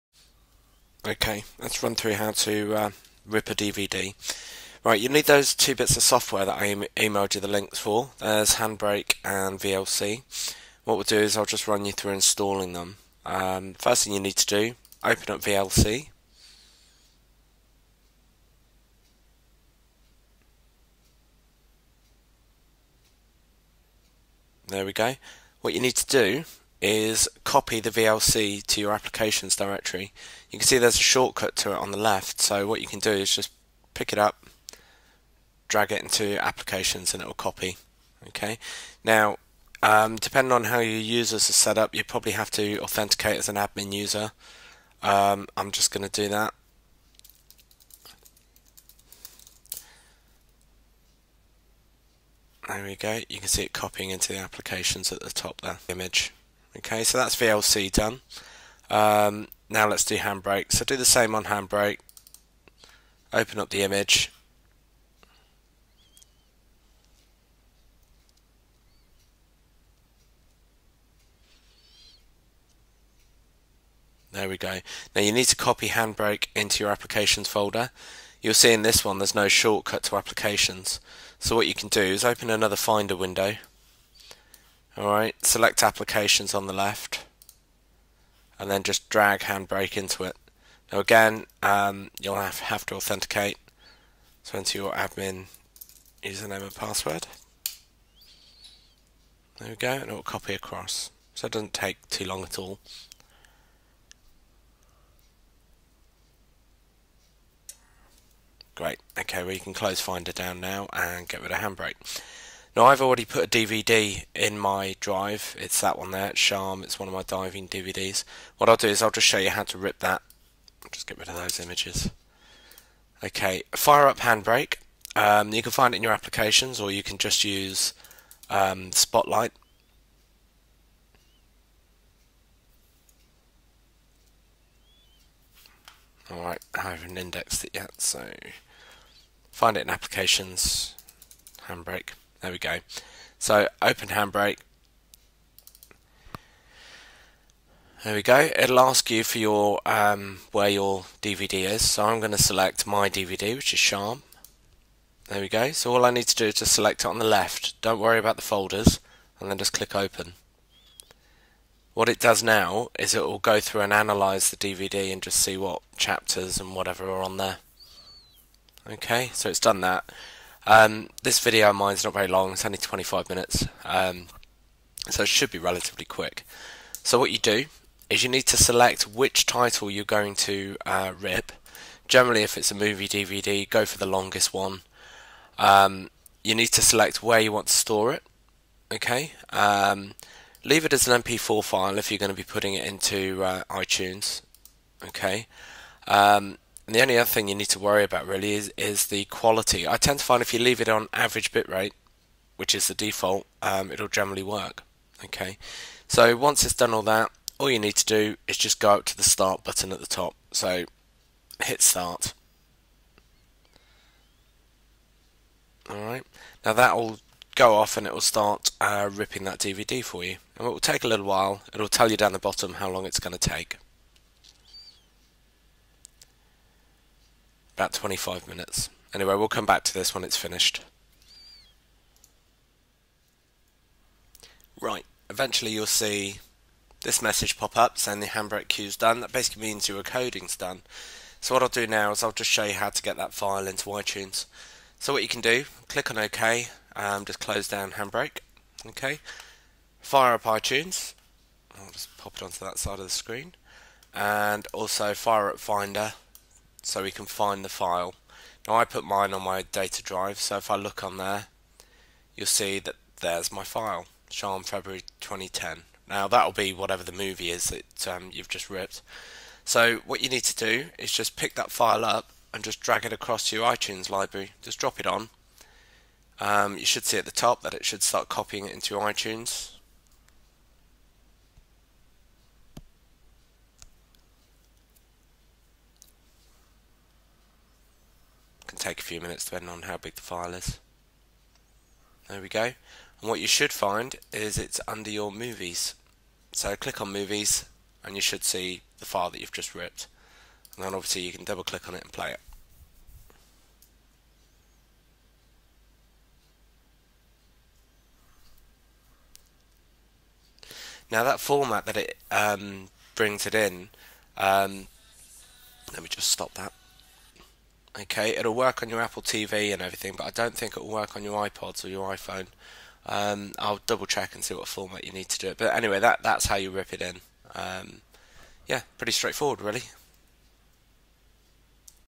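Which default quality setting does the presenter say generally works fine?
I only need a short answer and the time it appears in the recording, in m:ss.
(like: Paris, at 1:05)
average bitrate, at 3:21.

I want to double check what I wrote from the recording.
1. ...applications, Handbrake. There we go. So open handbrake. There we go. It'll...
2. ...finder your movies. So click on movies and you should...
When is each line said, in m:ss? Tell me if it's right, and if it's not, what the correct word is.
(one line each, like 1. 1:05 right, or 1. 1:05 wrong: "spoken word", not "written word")
1. 2:19 right
2. 4:54 wrong: "under", not "finder".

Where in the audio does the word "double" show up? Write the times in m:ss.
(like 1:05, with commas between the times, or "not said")
5:01, 5:23.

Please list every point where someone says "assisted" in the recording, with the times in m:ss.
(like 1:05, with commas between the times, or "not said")
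not said.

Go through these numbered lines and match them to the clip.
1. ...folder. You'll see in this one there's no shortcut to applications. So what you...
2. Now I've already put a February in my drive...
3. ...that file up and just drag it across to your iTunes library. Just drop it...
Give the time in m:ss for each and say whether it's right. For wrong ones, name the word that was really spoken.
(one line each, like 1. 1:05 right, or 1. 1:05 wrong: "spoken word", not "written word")
1. 1:17 right
2. 1:52 wrong: "DVD", not "February"
3. 4:31 right.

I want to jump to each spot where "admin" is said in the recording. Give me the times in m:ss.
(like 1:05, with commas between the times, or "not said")
0:43, 1:34.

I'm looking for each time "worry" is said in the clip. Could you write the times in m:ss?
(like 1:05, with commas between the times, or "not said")
2:37, 3:17.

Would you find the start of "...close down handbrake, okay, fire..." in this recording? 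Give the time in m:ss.
4:07.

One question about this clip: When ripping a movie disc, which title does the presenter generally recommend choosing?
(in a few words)
the longest one.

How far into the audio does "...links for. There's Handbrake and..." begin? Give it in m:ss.
0:07.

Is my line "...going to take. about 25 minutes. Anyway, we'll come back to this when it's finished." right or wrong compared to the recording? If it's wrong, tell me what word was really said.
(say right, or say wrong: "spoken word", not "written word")
right.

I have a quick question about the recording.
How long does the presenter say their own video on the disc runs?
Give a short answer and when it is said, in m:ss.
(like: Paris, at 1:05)
25 minutes, at 2:52.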